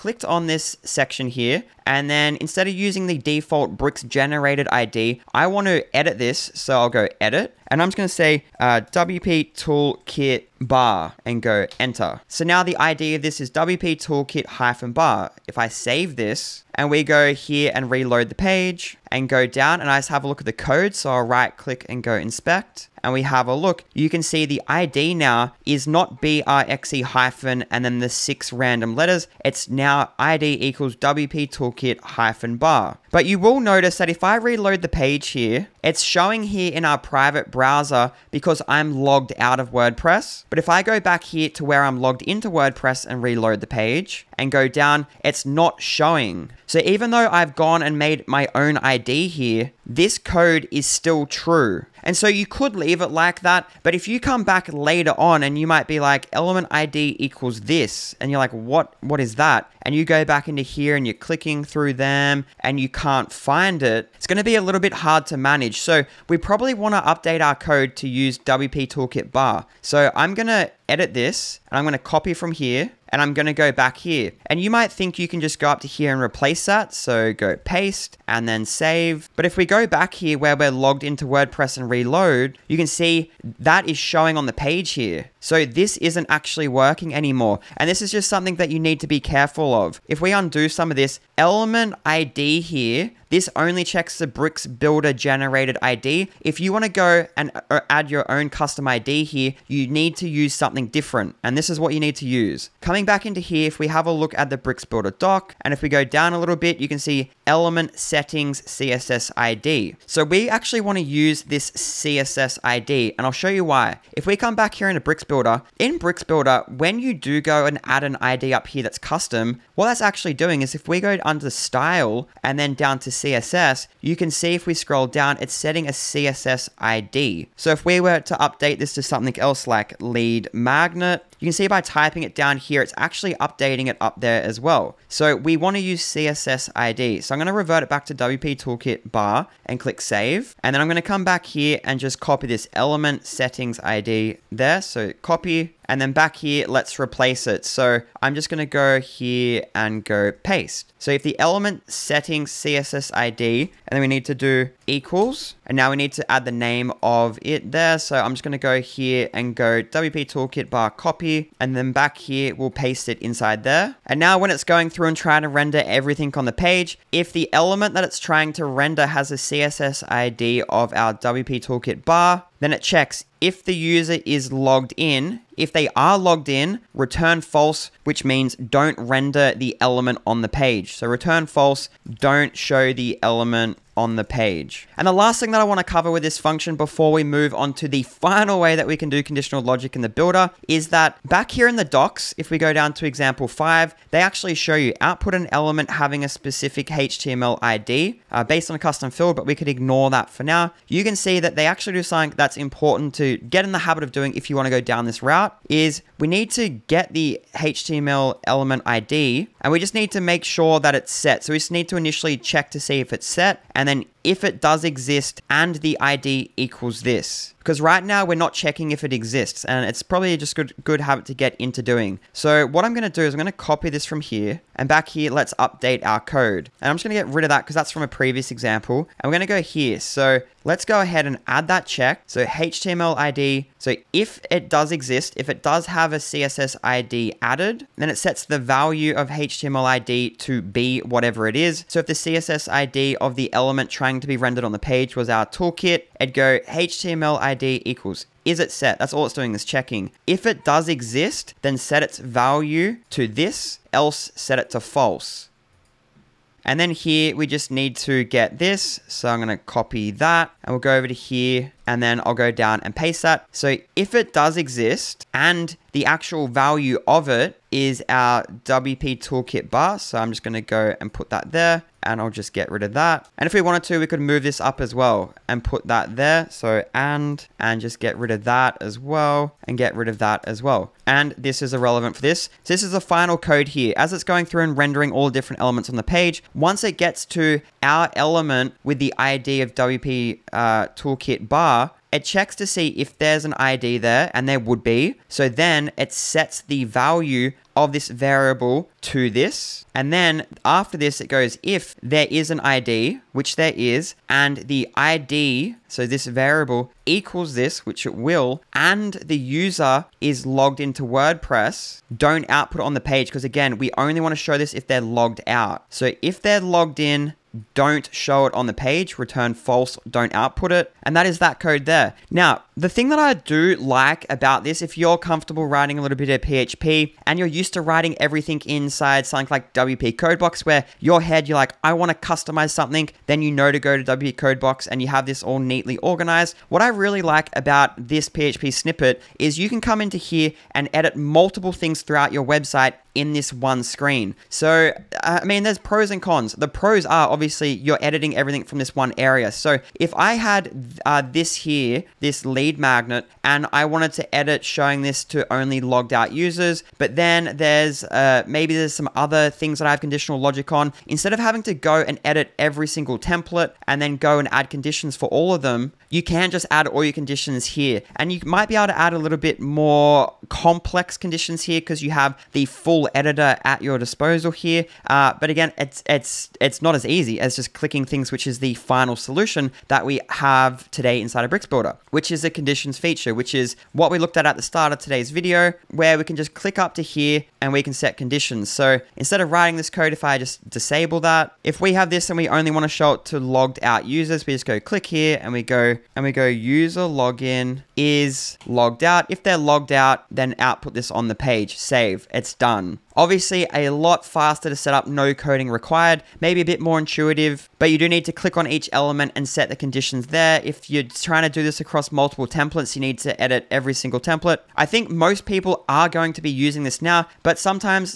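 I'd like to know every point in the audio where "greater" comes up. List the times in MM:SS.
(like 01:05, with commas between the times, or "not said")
not said.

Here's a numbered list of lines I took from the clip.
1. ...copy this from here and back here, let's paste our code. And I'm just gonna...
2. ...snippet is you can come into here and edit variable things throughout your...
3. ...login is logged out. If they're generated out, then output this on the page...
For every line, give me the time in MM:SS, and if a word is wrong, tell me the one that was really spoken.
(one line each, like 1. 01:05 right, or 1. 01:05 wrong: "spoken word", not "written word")
1. 03:43 wrong: "update", not "paste"
2. 05:38 wrong: "multiple", not "variable"
3. 06:37 wrong: "logged", not "generated".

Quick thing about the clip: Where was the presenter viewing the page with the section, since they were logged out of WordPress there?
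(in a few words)
private browser.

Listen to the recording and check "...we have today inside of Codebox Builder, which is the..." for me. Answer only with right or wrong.
wrong.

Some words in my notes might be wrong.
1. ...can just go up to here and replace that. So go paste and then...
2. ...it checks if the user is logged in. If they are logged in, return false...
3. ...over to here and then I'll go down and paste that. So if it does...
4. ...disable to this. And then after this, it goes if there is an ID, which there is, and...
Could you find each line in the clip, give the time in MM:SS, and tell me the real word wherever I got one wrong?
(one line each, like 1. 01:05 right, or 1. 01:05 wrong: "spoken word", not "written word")
1. 01:15 right
2. 02:52 right
3. 04:20 right
4. 04:58 wrong: "variable", not "disable".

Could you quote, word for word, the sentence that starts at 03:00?
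So return false, don't show the element on the page.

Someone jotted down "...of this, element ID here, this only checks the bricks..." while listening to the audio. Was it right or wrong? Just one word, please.
right.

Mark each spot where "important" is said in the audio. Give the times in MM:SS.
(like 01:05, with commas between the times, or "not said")
03:22.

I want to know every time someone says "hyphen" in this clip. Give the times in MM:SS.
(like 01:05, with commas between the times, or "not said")
00:14, 00:27.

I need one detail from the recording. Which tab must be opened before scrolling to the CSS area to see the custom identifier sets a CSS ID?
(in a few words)
style.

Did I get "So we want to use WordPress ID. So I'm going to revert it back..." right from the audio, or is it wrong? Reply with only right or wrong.
wrong.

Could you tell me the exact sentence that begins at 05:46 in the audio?
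The pros are obviously you're editing everything from this one area.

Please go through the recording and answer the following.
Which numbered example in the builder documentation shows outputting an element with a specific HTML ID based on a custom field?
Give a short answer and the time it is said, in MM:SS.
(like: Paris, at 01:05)
example five, at 03:13.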